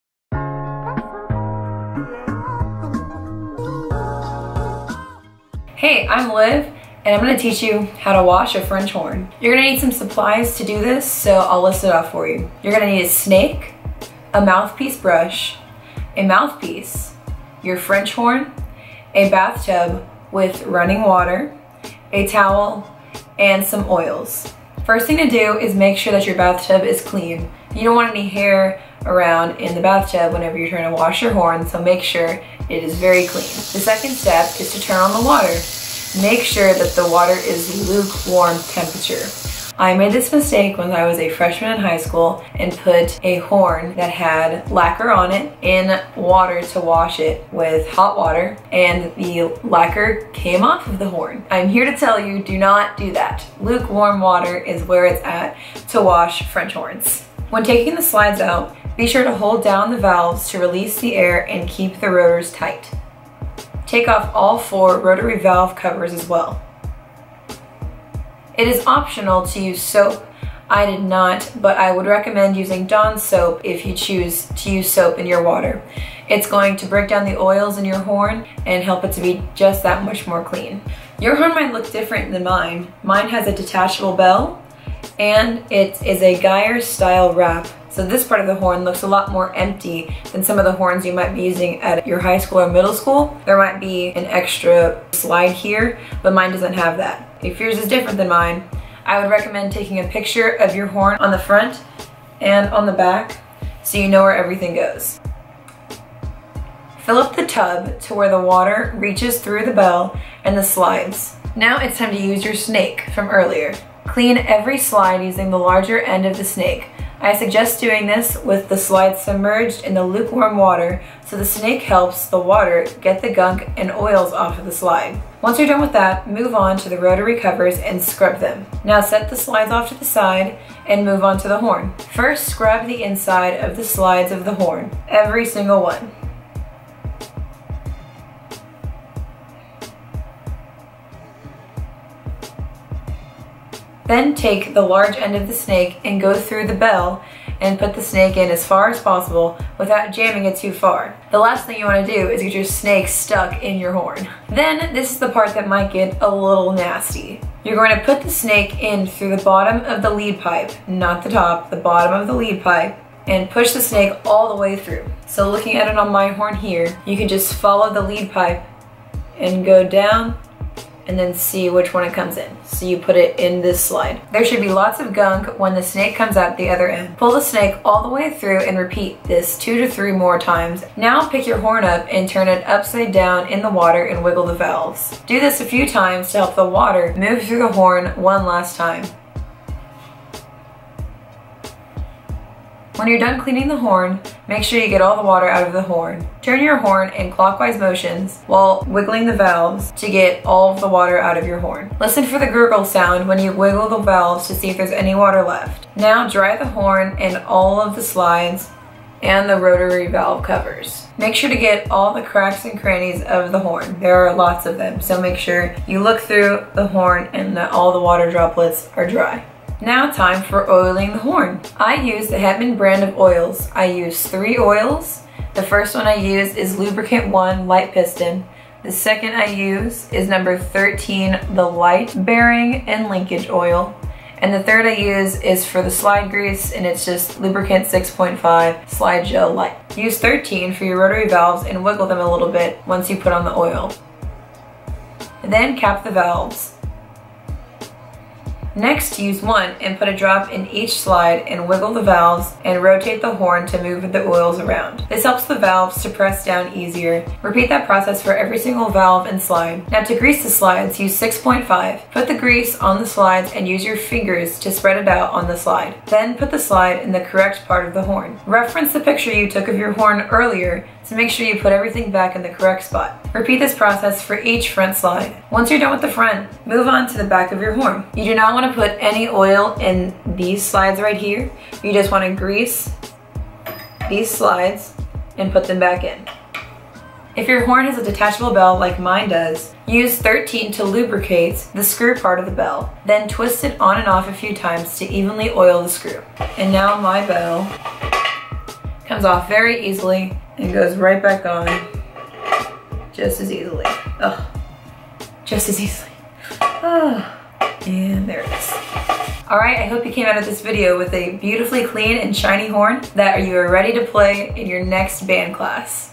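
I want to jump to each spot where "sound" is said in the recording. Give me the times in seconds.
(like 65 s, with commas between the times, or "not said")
202 s.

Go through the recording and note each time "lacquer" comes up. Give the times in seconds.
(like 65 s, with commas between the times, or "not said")
44 s, 49 s.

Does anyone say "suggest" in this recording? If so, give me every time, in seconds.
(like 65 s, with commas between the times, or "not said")
117 s.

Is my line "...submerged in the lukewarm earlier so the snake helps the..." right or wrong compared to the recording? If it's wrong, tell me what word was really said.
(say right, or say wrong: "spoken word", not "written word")
wrong: "water", not "earlier".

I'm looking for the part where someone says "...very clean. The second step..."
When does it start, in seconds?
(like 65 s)
32 s.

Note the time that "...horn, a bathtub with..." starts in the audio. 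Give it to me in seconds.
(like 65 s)
18 s.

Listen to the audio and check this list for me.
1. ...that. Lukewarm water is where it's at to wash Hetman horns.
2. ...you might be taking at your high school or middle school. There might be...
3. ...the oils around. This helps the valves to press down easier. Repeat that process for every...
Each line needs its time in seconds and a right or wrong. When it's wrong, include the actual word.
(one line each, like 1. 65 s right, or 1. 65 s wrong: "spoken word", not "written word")
1. 53 s wrong: "French", not "Hetman"
2. 91 s wrong: "using", not "taking"
3. 254 s right.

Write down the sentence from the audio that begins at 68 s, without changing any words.
It is optional to use soap.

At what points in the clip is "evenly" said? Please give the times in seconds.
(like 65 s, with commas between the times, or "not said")
295 s.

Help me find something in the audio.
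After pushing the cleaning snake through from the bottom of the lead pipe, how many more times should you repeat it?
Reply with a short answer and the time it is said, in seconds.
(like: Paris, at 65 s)
2 to 3, at 179 s.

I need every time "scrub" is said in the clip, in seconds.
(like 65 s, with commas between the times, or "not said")
128 s, 132 s.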